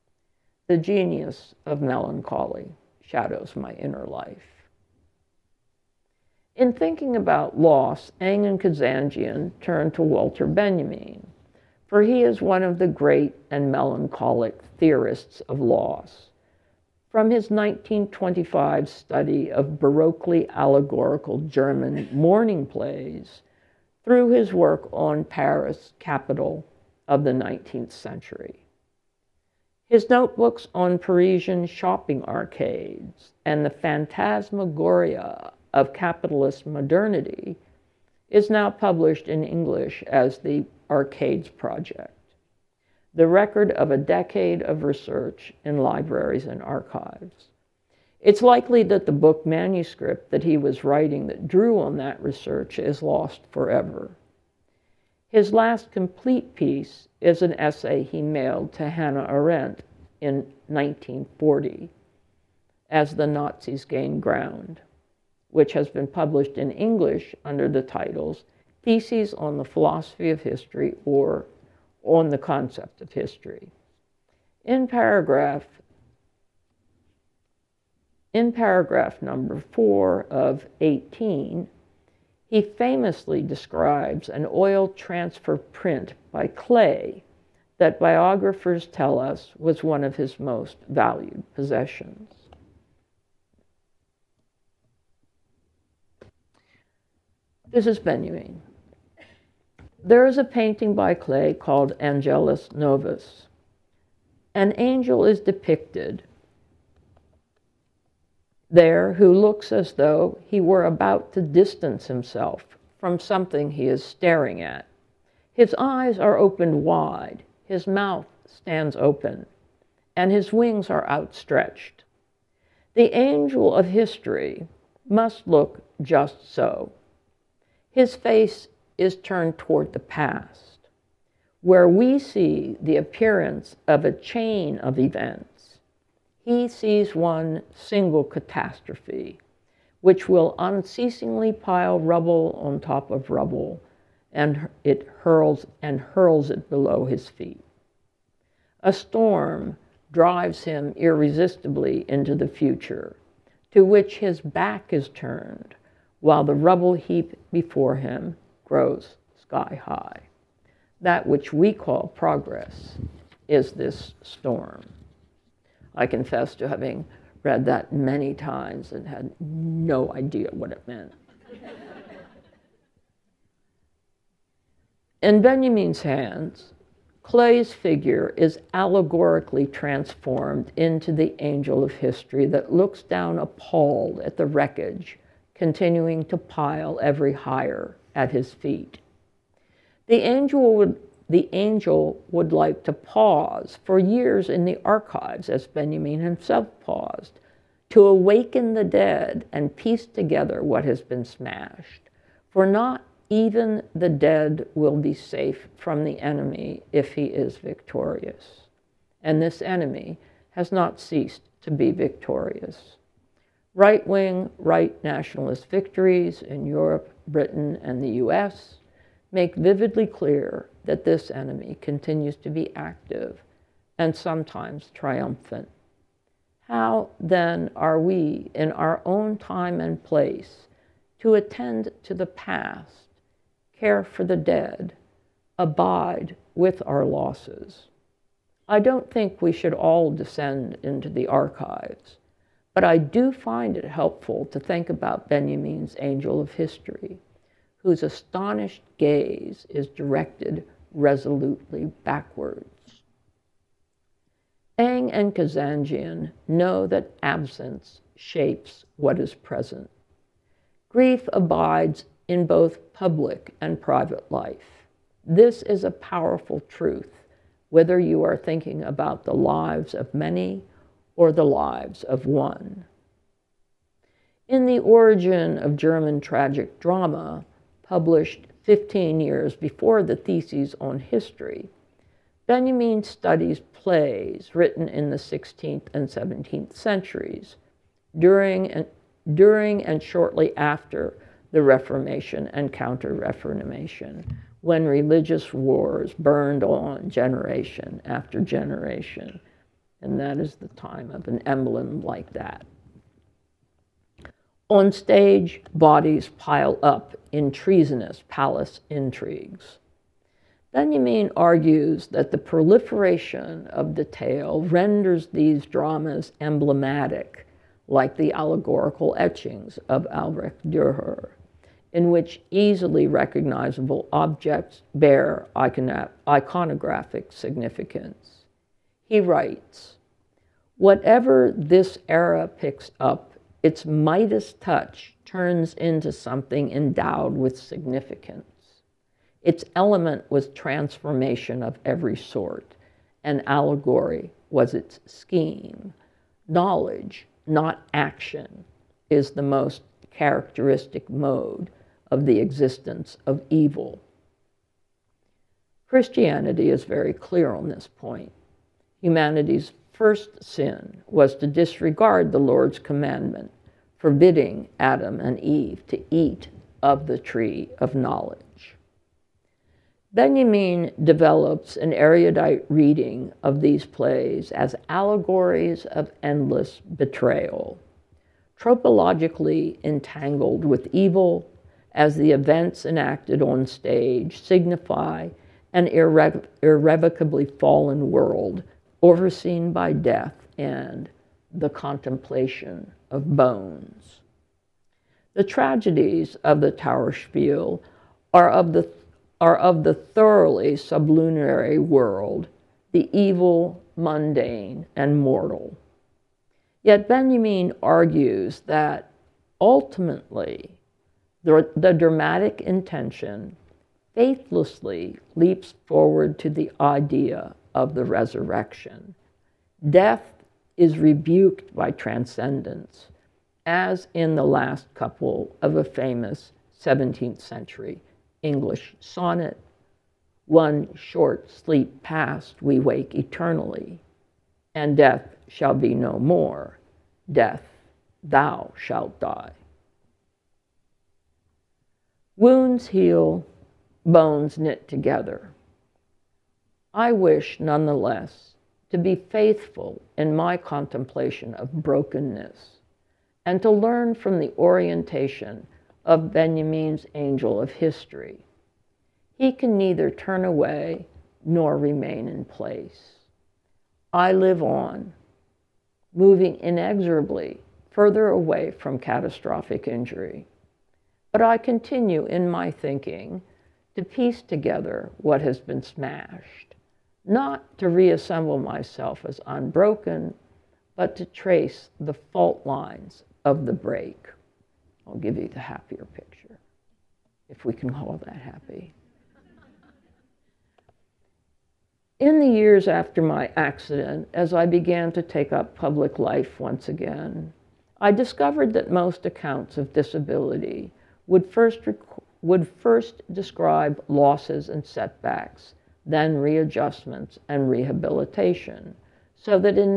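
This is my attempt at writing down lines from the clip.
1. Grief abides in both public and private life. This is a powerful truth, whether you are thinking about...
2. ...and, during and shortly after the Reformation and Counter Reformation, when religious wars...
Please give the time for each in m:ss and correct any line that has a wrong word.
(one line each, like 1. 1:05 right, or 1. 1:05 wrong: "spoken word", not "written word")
1. 4:20 right
2. 4:48 right.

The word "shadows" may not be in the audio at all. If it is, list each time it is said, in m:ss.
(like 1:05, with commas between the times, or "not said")
0:03.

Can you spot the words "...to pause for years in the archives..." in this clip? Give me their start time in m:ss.
3:12.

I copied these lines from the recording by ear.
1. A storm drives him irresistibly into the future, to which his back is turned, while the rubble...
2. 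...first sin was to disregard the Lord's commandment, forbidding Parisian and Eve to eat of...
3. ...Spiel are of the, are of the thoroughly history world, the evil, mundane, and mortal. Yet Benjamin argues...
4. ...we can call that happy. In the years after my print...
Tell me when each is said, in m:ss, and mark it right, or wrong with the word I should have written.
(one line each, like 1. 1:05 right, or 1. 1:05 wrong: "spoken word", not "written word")
1. 2:28 right
2. 5:59 wrong: "Adam", not "Parisian"
3. 6:37 wrong: "sublunary", not "history"
4. 8:07 wrong: "accident", not "print".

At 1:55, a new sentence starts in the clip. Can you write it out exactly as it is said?
His eyes are opened wide, his mouth stands open, and his wings are outstretched.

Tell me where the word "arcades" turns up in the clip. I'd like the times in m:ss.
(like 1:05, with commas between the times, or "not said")
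0:32, 0:40.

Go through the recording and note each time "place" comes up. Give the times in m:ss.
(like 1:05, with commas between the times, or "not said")
3:50, 7:42.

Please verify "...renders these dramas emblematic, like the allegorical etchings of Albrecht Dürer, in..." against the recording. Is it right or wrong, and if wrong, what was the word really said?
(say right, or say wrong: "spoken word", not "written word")
right.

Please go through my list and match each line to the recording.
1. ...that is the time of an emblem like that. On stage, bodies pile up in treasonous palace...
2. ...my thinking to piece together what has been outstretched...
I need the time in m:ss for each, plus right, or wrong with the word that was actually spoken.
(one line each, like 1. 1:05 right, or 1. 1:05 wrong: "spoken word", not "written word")
1. 5:00 right
2. 7:52 wrong: "smashed", not "outstretched".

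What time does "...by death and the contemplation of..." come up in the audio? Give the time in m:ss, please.
6:29.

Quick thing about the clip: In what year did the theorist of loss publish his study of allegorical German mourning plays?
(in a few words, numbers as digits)
1925.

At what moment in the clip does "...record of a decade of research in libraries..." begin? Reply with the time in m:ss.
0:43.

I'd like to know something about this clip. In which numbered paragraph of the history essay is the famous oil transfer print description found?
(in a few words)
4.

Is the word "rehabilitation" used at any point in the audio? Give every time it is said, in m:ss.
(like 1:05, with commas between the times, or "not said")
8:27.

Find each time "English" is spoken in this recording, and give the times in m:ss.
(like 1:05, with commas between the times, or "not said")
0:39, 1:06, 7:08.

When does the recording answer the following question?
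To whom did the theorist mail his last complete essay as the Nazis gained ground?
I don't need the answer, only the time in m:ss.
0:58.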